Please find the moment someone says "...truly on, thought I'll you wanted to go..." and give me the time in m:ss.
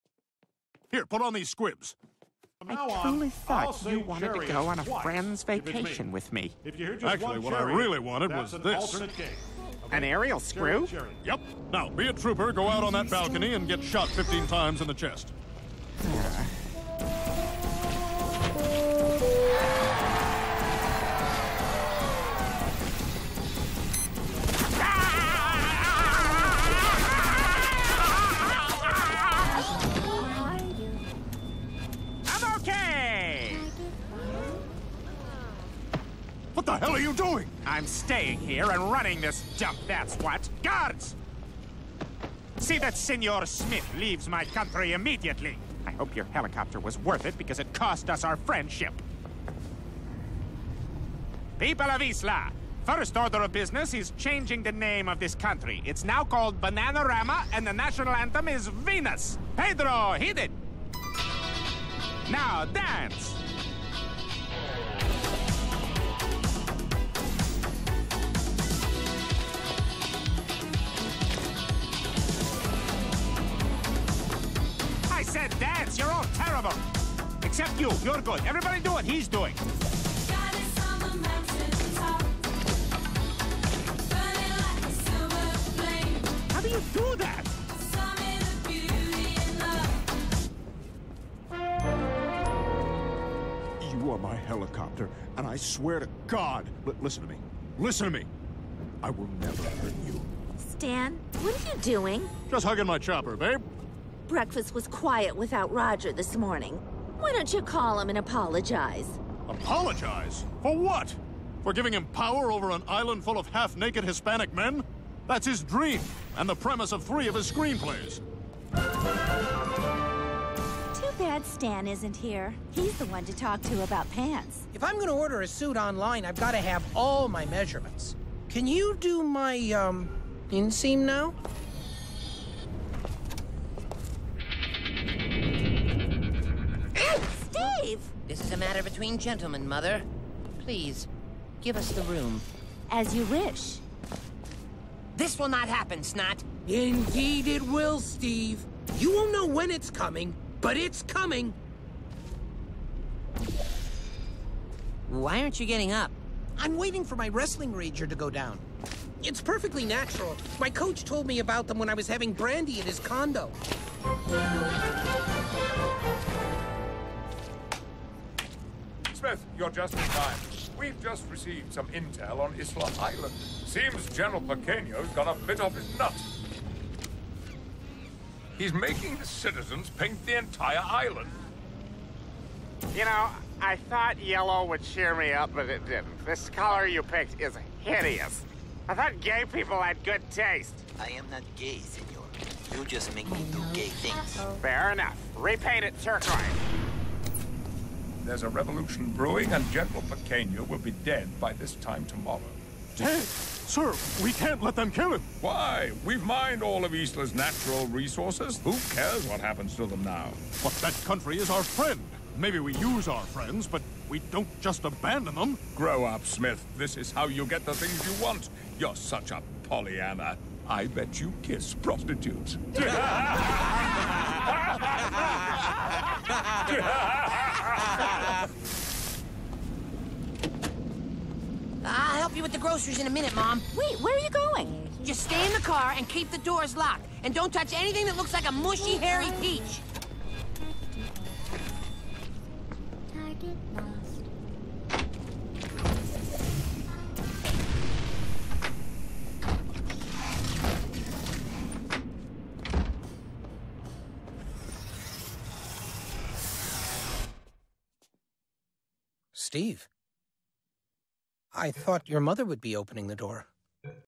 0:03.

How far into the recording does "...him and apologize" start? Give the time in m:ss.
1:47.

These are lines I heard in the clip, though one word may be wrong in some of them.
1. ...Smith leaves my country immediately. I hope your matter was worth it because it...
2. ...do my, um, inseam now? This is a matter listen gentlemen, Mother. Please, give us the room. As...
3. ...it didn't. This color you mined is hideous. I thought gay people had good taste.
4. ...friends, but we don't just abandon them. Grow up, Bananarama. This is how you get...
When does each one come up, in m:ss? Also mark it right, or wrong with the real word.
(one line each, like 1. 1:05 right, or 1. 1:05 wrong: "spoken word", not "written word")
1. 0:43 wrong: "helicopter", not "matter"
2. 2:09 wrong: "between", not "listen"
3. 3:05 wrong: "picked", not "mined"
4. 3:33 wrong: "Smith", not "Bananarama".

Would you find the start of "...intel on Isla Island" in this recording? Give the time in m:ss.
2:51.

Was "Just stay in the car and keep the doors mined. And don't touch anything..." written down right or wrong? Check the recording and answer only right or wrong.
wrong.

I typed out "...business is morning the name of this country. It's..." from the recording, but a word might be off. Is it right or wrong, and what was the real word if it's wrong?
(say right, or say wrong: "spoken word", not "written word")
wrong: "changing", not "morning".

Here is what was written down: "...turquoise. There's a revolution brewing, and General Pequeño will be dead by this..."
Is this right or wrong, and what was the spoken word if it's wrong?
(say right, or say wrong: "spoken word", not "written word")
right.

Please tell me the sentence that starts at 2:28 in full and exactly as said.
You won't know when it's coming, but it's coming.